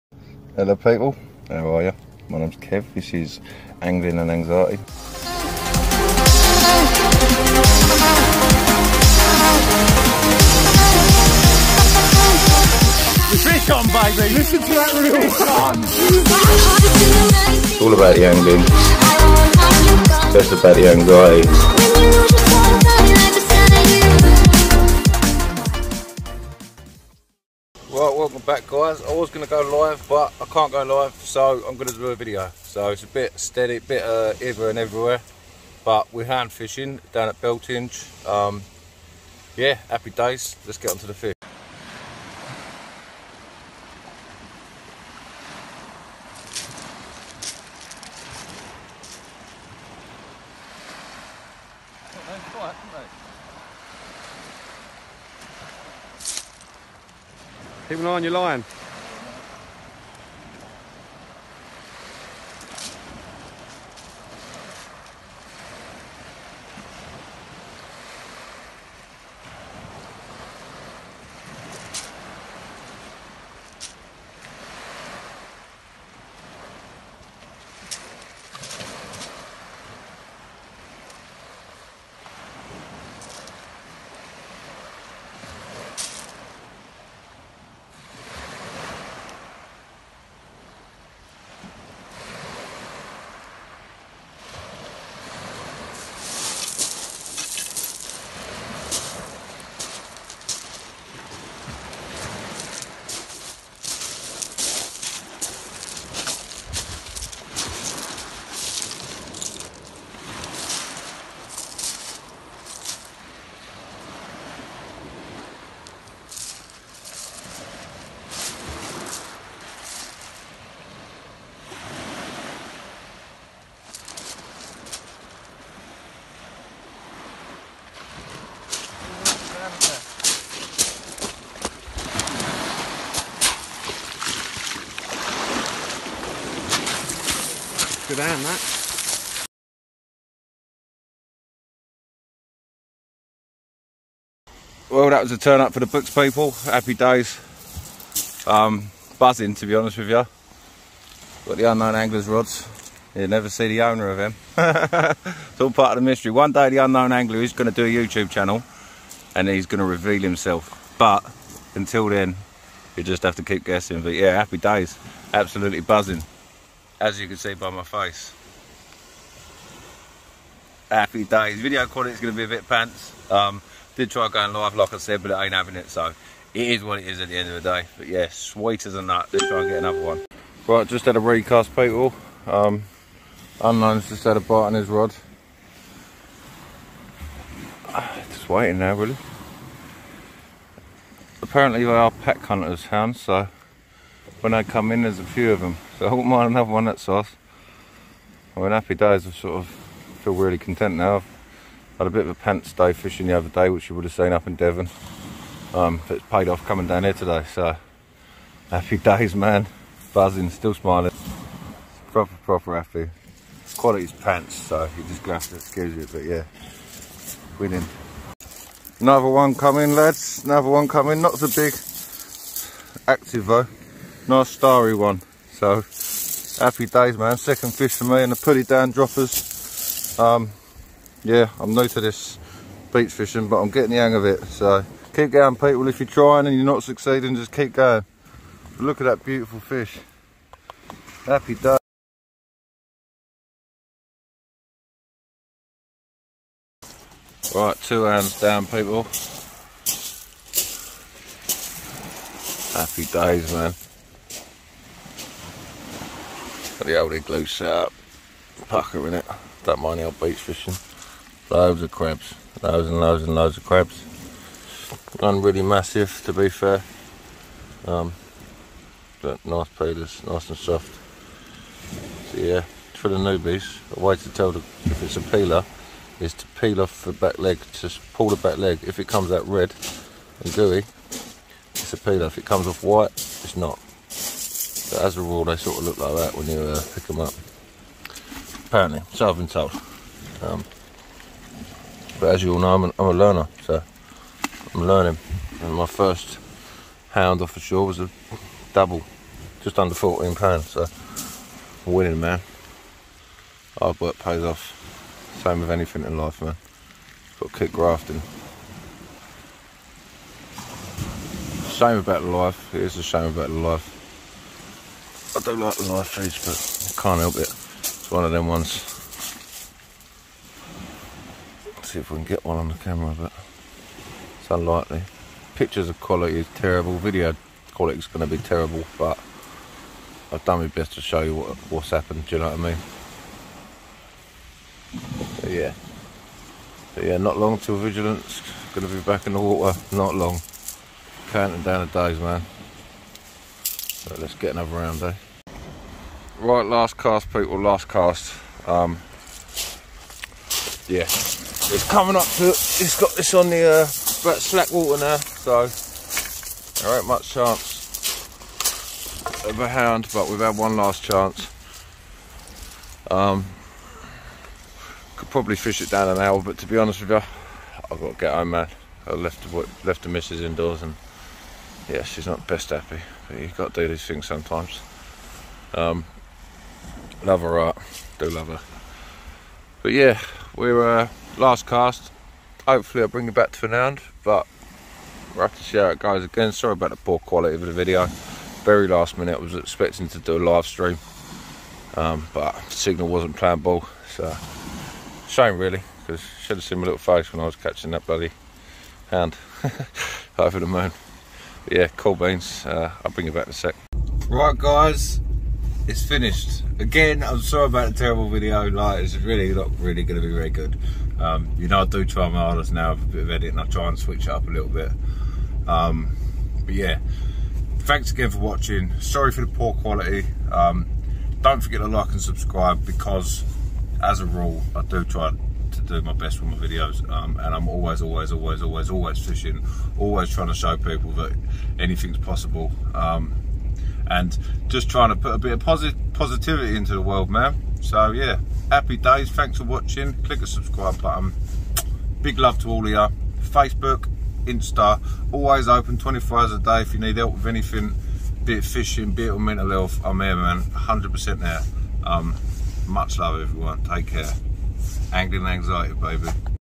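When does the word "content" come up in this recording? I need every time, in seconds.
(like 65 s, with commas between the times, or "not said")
200 s.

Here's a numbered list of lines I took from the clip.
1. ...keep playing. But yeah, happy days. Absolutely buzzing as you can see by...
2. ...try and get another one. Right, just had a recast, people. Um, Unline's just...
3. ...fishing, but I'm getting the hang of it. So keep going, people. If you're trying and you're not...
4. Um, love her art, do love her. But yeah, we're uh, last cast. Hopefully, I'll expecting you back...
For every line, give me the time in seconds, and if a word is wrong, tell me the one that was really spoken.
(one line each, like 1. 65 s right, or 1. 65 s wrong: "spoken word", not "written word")
1. 163 s wrong: "guessing", not "playing"
2. 179 s right
3. 233 s right
4. 375 s wrong: "bring", not "expecting".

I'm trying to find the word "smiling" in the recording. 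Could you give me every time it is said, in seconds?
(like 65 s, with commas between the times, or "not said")
210 s.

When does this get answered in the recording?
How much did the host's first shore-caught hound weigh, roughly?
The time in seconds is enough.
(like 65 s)
299 s.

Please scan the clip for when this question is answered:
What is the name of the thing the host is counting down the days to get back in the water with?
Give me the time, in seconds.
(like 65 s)
337 s.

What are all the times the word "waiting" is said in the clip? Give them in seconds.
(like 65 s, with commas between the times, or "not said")
188 s.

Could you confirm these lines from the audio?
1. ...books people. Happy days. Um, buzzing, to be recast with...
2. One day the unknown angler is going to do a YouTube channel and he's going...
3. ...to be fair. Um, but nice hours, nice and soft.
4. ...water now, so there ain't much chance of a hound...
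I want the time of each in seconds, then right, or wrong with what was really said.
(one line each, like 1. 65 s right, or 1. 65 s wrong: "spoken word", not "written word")
1. 145 s wrong: "honest", not "recast"
2. 156 s right
3. 266 s wrong: "peelers", not "hours"
4. 354 s right.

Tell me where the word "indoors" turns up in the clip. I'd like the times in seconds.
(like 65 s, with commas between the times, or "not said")
370 s.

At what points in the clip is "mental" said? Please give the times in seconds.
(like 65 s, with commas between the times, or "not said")
449 s.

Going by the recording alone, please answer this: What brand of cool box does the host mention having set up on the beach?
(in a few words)
Igloo.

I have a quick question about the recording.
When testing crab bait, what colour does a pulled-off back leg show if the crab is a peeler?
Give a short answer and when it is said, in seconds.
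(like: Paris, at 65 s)
Red, at 279 s.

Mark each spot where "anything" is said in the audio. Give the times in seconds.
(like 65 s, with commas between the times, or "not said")
305 s, 431 s, 447 s.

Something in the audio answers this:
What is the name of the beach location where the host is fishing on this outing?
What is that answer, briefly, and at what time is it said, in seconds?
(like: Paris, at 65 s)
Beltinge, at 37 s.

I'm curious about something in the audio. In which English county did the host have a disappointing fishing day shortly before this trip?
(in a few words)
Devon.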